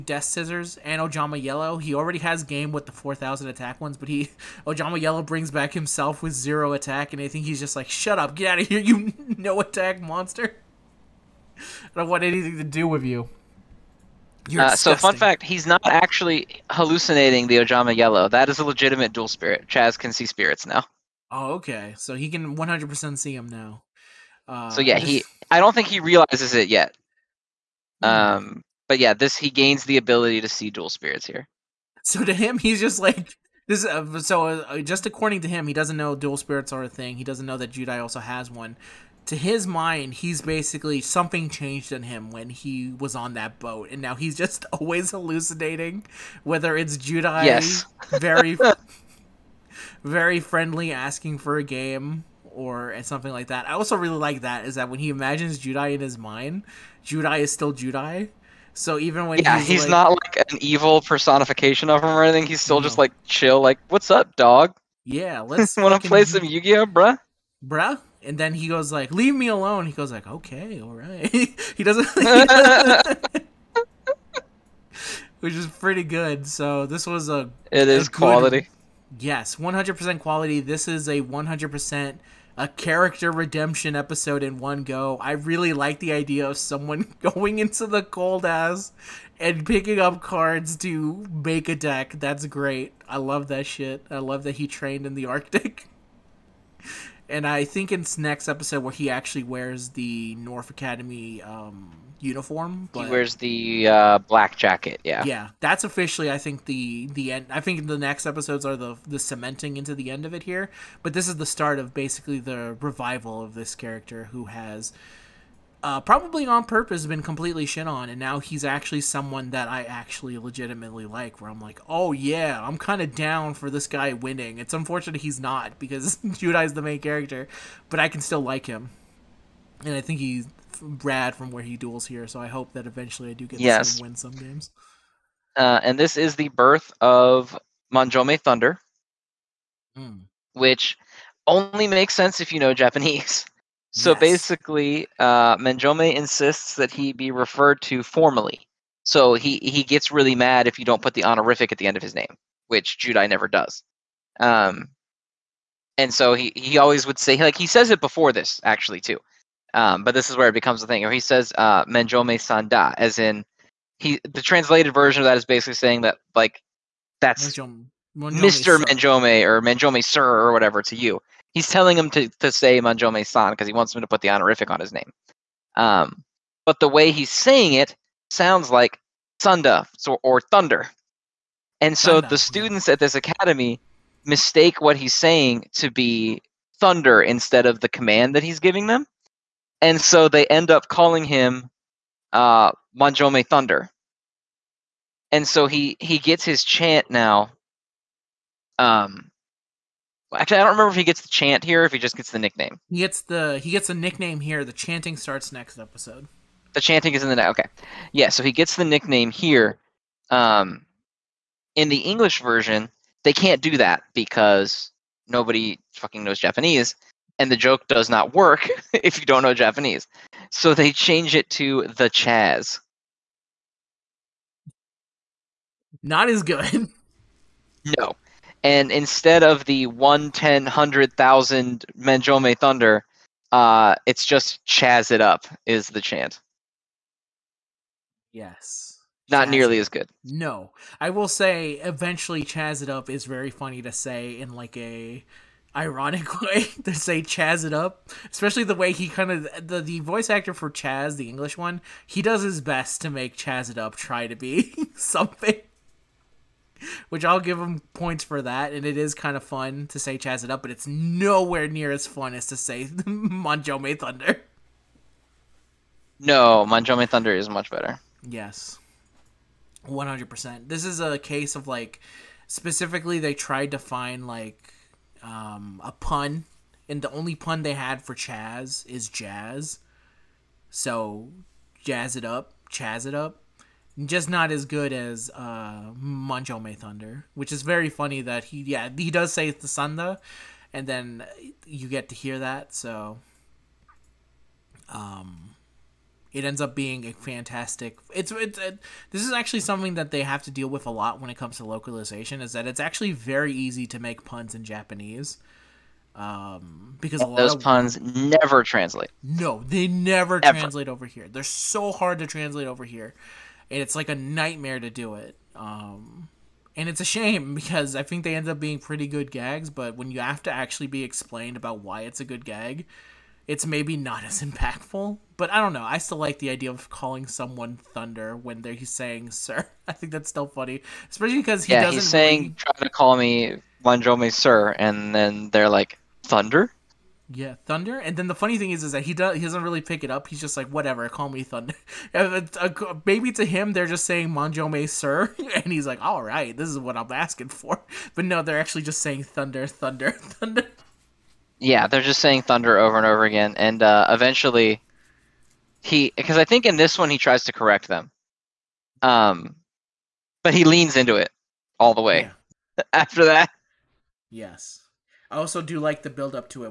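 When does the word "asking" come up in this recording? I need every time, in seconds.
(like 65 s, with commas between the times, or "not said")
50 s, 347 s.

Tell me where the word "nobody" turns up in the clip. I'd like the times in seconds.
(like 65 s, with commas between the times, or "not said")
215 s.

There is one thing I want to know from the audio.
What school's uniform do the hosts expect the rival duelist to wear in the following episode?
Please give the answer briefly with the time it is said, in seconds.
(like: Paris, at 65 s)
North Academy, at 100 s.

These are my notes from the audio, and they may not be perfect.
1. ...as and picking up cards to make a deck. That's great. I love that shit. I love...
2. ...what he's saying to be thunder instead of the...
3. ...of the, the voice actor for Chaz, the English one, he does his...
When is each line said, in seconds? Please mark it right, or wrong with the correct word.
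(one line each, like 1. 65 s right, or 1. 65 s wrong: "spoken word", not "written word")
1. 88 s right
2. 184 s right
3. 249 s right.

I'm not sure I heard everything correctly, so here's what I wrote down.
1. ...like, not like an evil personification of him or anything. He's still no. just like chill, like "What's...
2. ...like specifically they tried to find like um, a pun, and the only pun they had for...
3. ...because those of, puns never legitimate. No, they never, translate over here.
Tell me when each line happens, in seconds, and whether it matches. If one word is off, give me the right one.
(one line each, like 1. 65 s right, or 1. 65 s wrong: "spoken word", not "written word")
1. 59 s right
2. 271 s right
3. 307 s wrong: "translate", not "legitimate".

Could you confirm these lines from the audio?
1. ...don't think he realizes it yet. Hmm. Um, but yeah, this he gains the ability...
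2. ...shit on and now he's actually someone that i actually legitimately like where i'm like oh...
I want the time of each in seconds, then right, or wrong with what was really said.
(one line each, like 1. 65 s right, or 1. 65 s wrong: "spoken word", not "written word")
1. 25 s right
2. 117 s right.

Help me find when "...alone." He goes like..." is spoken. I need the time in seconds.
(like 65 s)
69 s.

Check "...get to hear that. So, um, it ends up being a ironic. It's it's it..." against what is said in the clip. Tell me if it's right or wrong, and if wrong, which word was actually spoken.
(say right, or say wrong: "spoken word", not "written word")
wrong: "fantastic", not "ironic".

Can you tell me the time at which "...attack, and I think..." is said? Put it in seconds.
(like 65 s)
6 s.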